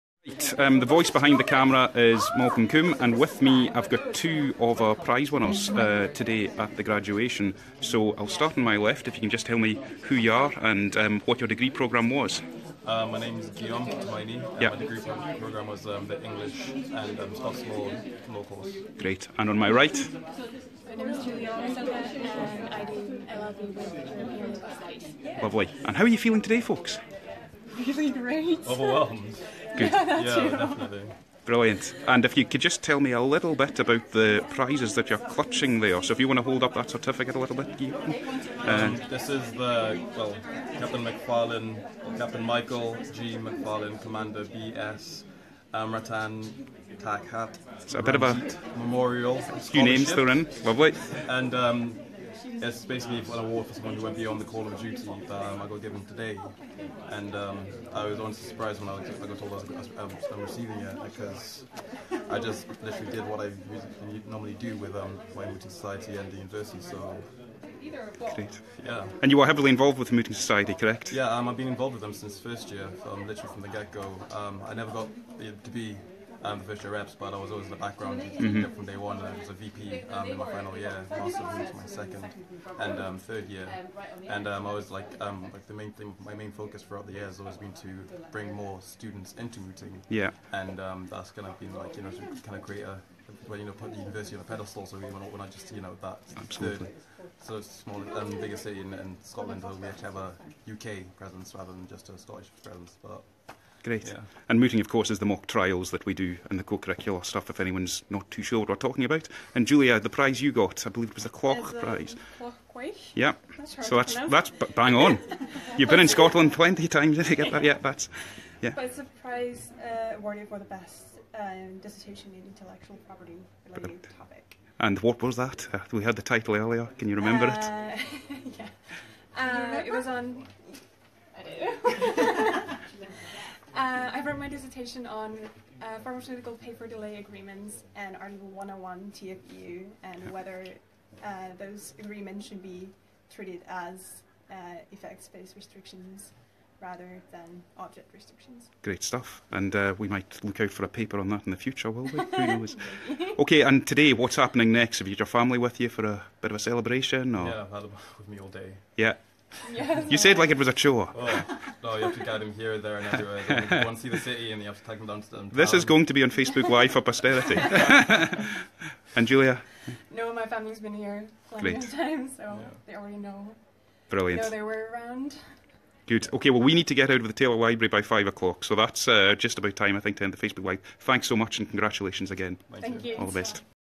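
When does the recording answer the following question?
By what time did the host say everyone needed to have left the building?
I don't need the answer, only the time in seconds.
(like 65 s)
178 s.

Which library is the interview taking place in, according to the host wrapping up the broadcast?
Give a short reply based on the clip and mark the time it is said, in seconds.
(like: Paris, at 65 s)
Taylor Library, at 177 s.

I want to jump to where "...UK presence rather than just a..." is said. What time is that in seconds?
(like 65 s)
100 s.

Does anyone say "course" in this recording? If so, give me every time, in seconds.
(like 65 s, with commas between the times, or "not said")
18 s, 104 s.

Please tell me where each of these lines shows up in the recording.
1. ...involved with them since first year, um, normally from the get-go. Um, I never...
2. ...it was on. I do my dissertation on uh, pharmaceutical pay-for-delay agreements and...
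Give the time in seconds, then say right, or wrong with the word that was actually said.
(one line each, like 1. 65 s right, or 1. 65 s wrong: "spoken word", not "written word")
1. 71 s wrong: "literally", not "normally"
2. 129 s right.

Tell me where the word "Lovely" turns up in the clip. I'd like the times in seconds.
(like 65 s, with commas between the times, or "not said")
25 s, 50 s.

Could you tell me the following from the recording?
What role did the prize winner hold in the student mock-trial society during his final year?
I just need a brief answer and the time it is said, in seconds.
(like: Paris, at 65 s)
VP, at 79 s.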